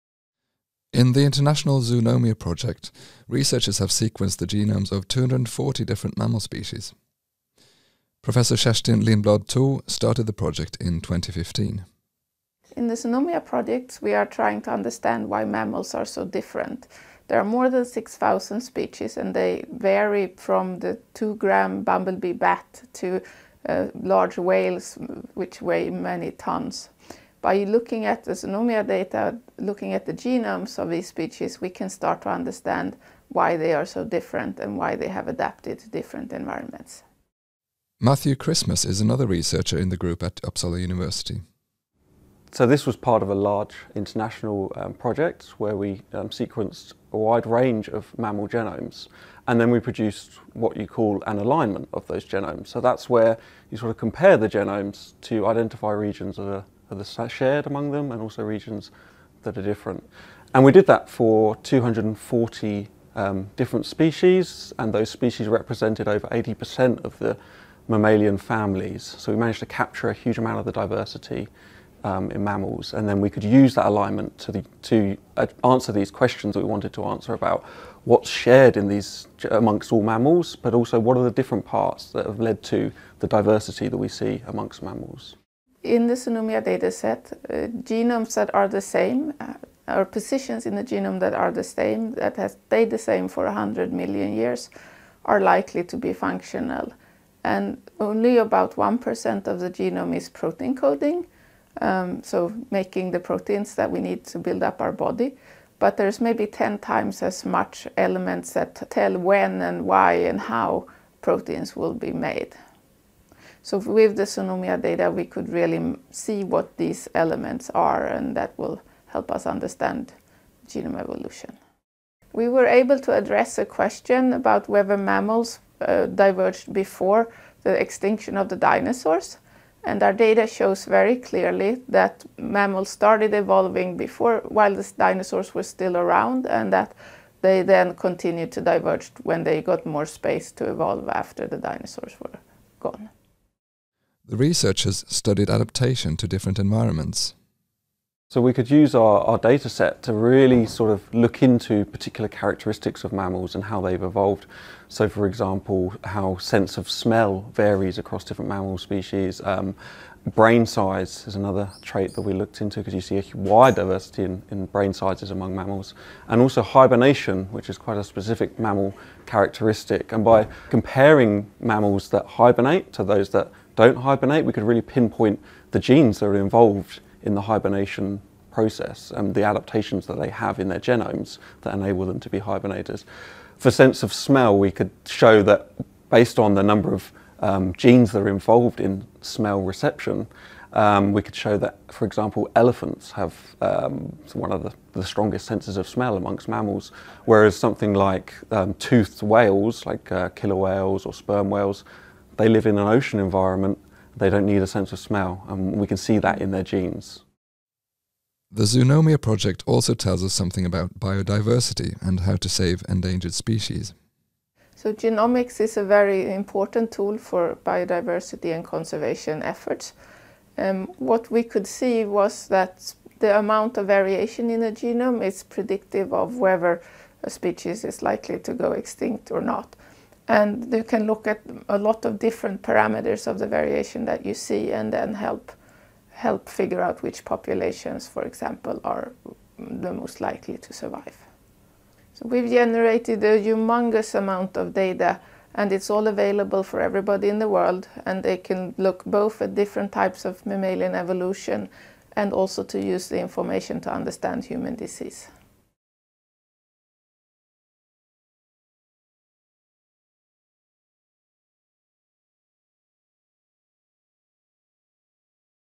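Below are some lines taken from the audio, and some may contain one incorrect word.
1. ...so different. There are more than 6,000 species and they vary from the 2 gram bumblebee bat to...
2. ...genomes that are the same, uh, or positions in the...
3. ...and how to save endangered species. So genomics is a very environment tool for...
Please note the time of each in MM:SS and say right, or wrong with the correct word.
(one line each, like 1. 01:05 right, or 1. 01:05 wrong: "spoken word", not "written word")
1. 00:16 right
2. 01:27 right
3. 03:32 wrong: "important", not "environment".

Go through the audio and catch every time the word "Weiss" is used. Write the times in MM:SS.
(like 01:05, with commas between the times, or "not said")
not said.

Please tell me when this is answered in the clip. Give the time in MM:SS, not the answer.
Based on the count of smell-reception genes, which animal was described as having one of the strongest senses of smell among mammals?
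03:12.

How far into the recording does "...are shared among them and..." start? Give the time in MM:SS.
00:57.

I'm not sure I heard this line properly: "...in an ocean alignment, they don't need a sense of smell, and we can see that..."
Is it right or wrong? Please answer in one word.
wrong.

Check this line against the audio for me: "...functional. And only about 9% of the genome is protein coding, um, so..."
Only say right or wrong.
wrong.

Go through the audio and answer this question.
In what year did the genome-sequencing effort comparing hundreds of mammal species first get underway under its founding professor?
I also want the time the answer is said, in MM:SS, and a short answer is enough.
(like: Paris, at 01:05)
2015, at 00:11.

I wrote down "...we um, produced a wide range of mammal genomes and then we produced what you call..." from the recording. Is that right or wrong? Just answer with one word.
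wrong.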